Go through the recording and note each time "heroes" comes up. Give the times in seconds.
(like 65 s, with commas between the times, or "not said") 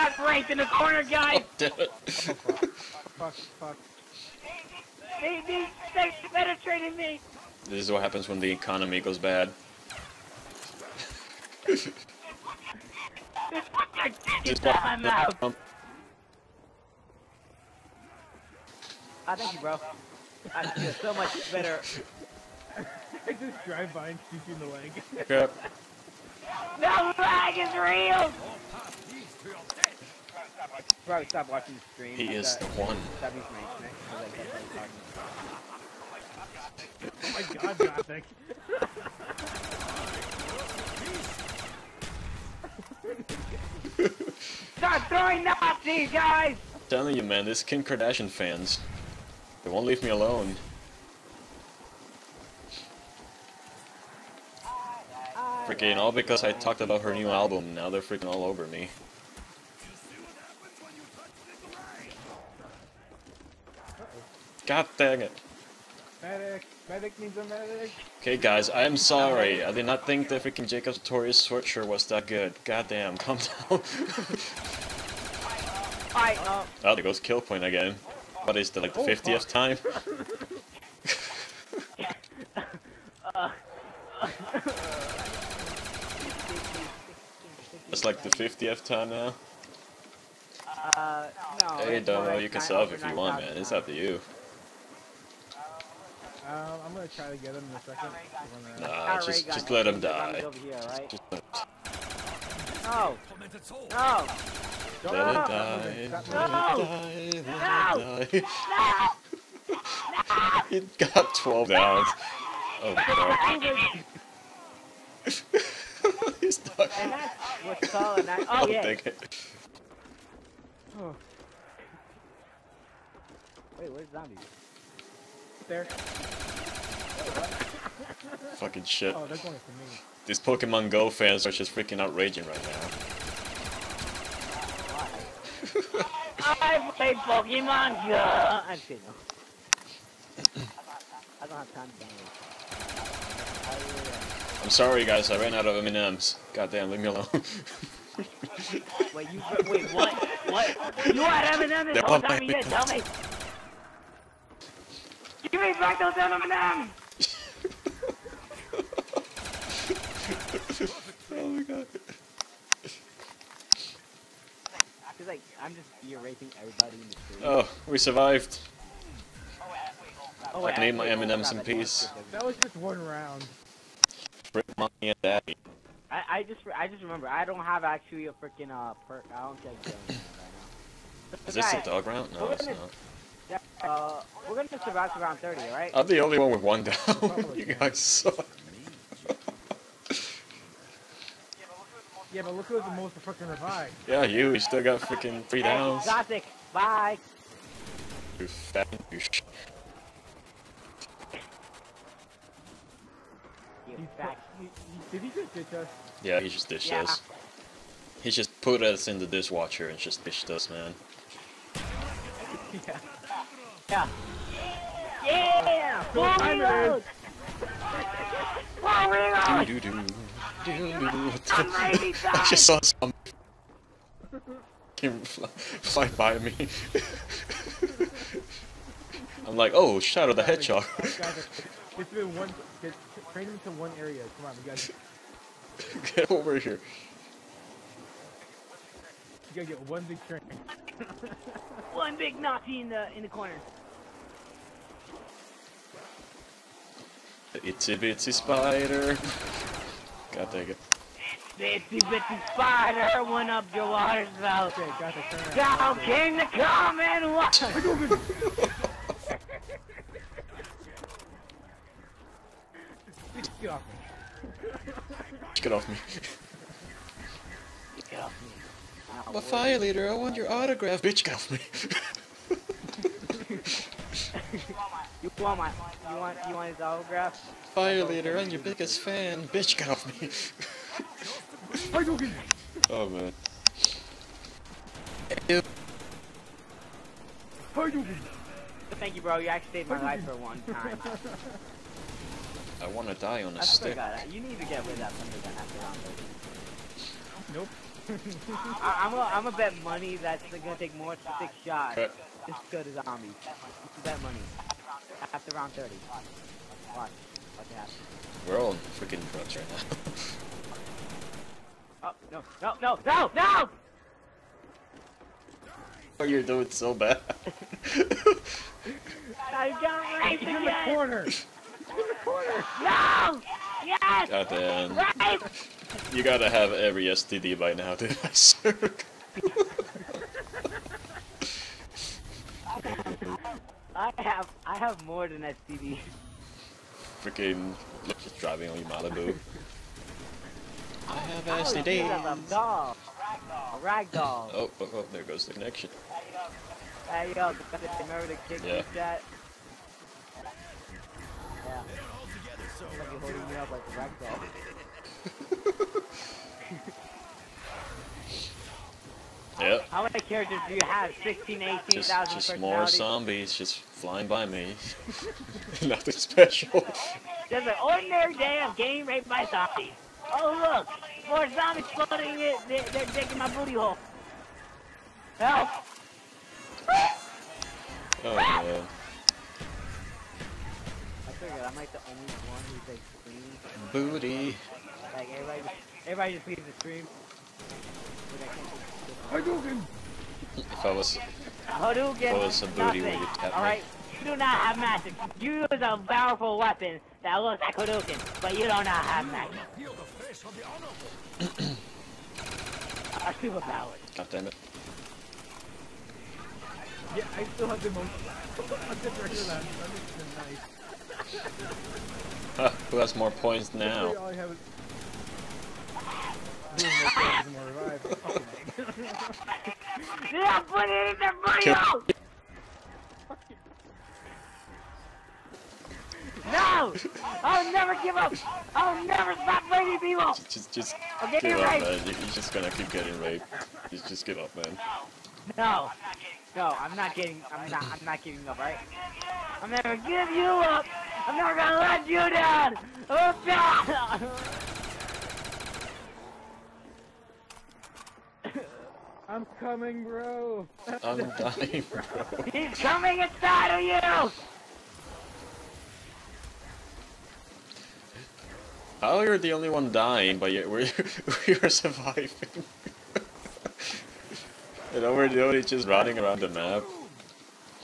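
not said.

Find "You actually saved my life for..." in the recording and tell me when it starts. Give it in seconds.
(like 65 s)
289 s.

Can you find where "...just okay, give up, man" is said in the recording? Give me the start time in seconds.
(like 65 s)
430 s.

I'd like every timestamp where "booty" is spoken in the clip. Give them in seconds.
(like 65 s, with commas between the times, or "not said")
373 s, 383 s, 392 s.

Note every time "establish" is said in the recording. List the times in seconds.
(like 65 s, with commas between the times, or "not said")
not said.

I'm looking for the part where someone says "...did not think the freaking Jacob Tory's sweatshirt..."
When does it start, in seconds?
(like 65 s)
69 s.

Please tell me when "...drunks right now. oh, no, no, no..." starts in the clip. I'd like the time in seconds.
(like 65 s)
309 s.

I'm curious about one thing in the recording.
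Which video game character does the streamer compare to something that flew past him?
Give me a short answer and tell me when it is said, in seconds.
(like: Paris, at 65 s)
Shadow the Hedgehog, at 230 s.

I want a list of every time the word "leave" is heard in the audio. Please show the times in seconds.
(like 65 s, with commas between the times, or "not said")
49 s, 146 s, 386 s.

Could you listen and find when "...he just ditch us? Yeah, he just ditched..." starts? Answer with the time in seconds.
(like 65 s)
205 s.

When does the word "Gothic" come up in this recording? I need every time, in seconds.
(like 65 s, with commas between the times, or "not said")
37 s.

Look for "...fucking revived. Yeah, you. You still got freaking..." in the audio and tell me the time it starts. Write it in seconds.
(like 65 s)
193 s.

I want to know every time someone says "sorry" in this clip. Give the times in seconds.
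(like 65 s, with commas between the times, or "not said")
68 s, 144 s.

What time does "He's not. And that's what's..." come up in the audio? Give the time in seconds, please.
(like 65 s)
116 s.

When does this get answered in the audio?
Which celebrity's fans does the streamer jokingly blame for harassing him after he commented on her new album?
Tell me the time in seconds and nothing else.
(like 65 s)
47 s.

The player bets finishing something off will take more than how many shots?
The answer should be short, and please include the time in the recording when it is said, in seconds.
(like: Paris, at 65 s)
6, at 301 s.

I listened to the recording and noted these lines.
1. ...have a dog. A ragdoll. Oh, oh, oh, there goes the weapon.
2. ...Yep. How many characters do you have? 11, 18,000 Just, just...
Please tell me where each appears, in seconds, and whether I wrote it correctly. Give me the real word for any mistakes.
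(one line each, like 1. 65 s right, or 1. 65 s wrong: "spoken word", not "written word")
1. 342 s wrong: "connection", not "weapon"
2. 359 s wrong: "16", not "11".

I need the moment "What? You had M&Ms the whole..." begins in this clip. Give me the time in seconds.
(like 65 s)
150 s.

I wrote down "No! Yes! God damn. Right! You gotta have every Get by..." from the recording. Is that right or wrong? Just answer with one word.
wrong.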